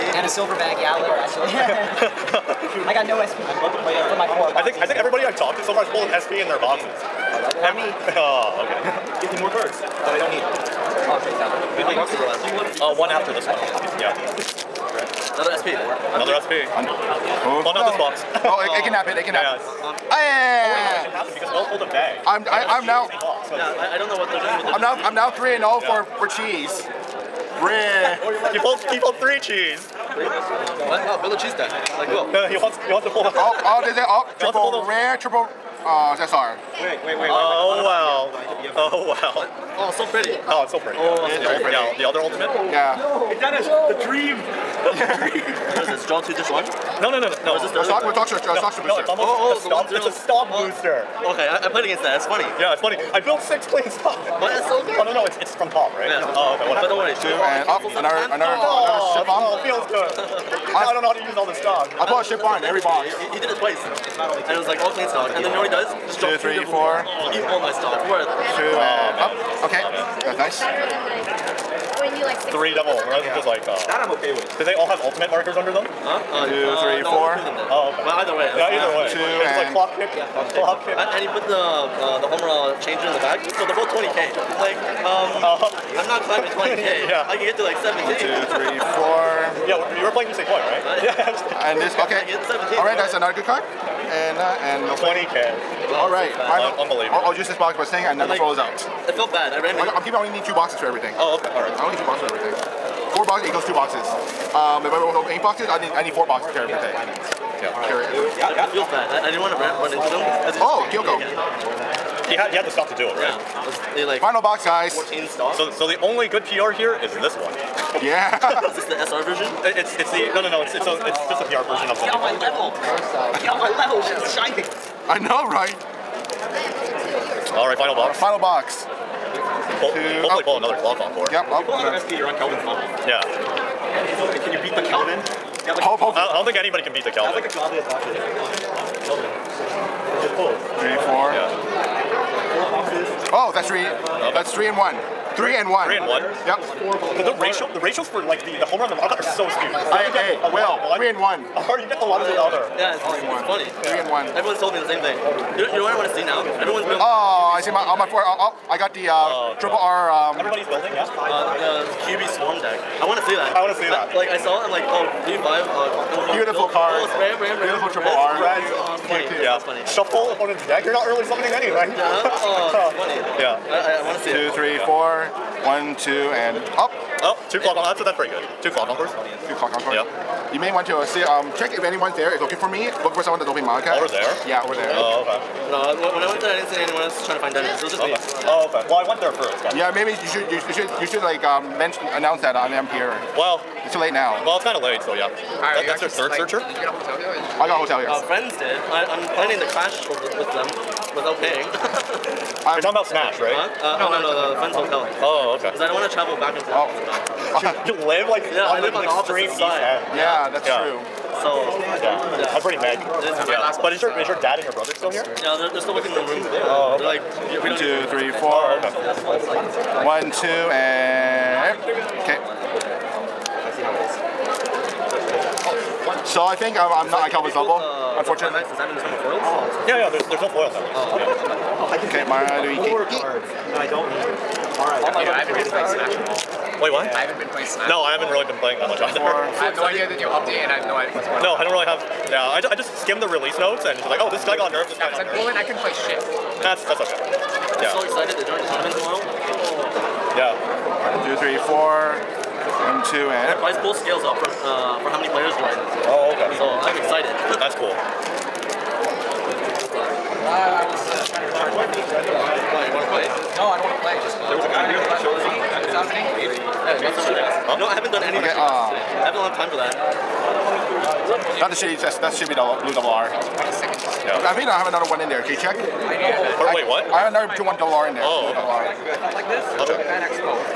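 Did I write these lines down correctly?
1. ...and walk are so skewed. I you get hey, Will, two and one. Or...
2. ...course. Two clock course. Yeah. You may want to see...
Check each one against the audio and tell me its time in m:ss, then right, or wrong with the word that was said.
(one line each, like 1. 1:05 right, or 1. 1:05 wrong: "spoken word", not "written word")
1. 2:28 wrong: "three", not "two"
2. 2:58 right.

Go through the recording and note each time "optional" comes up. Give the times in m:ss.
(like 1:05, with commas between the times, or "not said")
not said.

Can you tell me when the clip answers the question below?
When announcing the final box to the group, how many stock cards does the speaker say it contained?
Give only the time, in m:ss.
1:54.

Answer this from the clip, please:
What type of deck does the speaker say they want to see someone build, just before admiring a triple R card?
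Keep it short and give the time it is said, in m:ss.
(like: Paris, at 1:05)
QB Swarm, at 2:42.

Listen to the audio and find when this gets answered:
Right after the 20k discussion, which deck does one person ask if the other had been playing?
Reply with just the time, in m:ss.
1:30.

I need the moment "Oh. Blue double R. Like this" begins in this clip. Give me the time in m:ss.
4:38.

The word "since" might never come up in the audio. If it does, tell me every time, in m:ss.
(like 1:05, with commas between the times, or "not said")
not said.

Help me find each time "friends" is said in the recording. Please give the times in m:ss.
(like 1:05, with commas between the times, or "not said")
3:18, 3:24.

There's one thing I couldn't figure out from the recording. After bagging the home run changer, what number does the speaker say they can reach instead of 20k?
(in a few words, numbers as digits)
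17.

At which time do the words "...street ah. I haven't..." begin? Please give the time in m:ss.
4:28.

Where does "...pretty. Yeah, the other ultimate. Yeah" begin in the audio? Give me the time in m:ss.
0:41.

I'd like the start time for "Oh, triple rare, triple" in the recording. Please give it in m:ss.
0:34.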